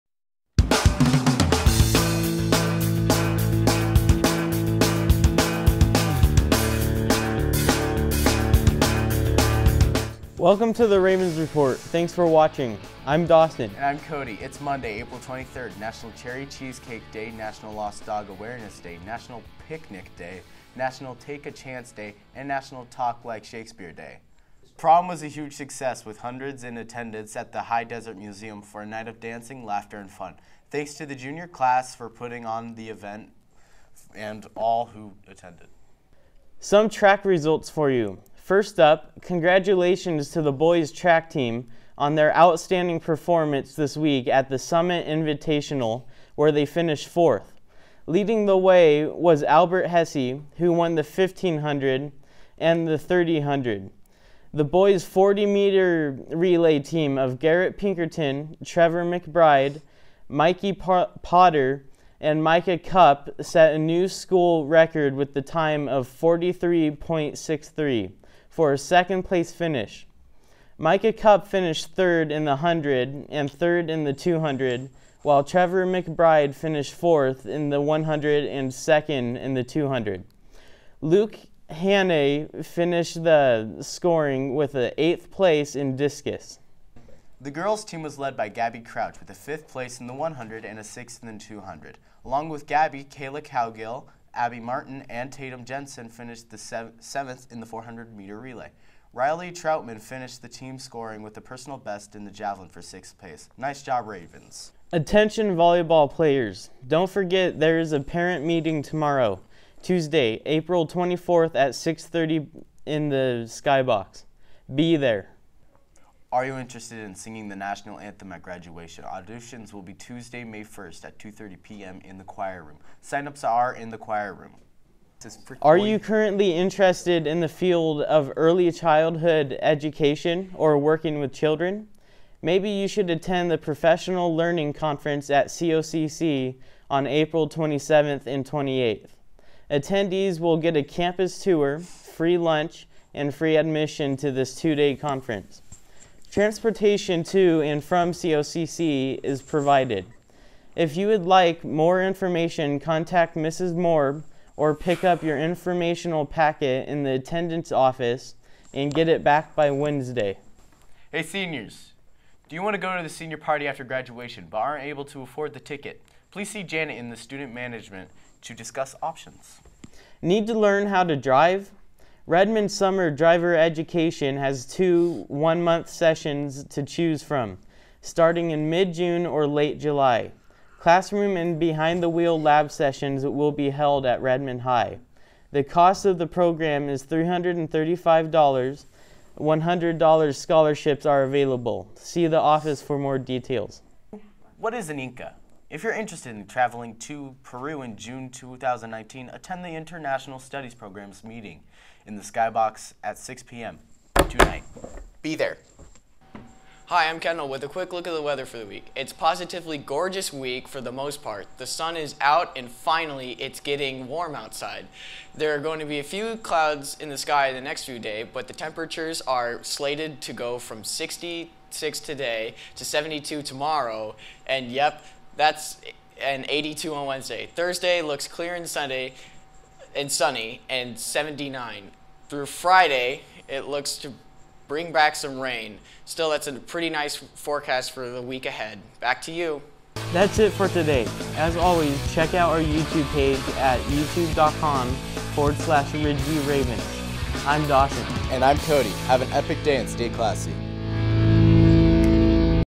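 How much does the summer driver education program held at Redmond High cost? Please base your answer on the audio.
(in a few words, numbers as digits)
$335.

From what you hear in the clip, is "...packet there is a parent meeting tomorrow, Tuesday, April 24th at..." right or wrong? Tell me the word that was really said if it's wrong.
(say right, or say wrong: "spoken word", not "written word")
wrong: "forget", not "packet".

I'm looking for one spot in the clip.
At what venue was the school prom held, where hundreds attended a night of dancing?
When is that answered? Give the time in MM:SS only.
00:27.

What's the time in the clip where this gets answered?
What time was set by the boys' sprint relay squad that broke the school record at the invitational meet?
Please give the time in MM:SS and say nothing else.
01:06.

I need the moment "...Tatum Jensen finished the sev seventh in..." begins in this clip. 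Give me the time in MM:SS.
01:35.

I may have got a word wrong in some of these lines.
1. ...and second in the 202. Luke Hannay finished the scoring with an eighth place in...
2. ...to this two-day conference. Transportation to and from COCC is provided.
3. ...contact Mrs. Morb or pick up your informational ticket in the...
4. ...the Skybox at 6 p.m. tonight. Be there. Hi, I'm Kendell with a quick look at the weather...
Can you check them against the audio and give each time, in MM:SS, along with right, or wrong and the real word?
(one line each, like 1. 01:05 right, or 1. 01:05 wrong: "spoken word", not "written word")
1. 01:18 wrong: "200", not "202"
2. 02:24 right
3. 02:32 wrong: "packet", not "ticket"
4. 03:22 right.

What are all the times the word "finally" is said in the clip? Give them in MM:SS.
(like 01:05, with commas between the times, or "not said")
03:32.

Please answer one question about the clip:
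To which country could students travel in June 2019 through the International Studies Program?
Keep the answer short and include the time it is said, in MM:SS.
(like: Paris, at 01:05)
Peru, at 03:17.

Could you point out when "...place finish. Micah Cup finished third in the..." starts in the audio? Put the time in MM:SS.
01:09.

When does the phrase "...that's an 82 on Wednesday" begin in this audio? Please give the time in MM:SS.
03:45.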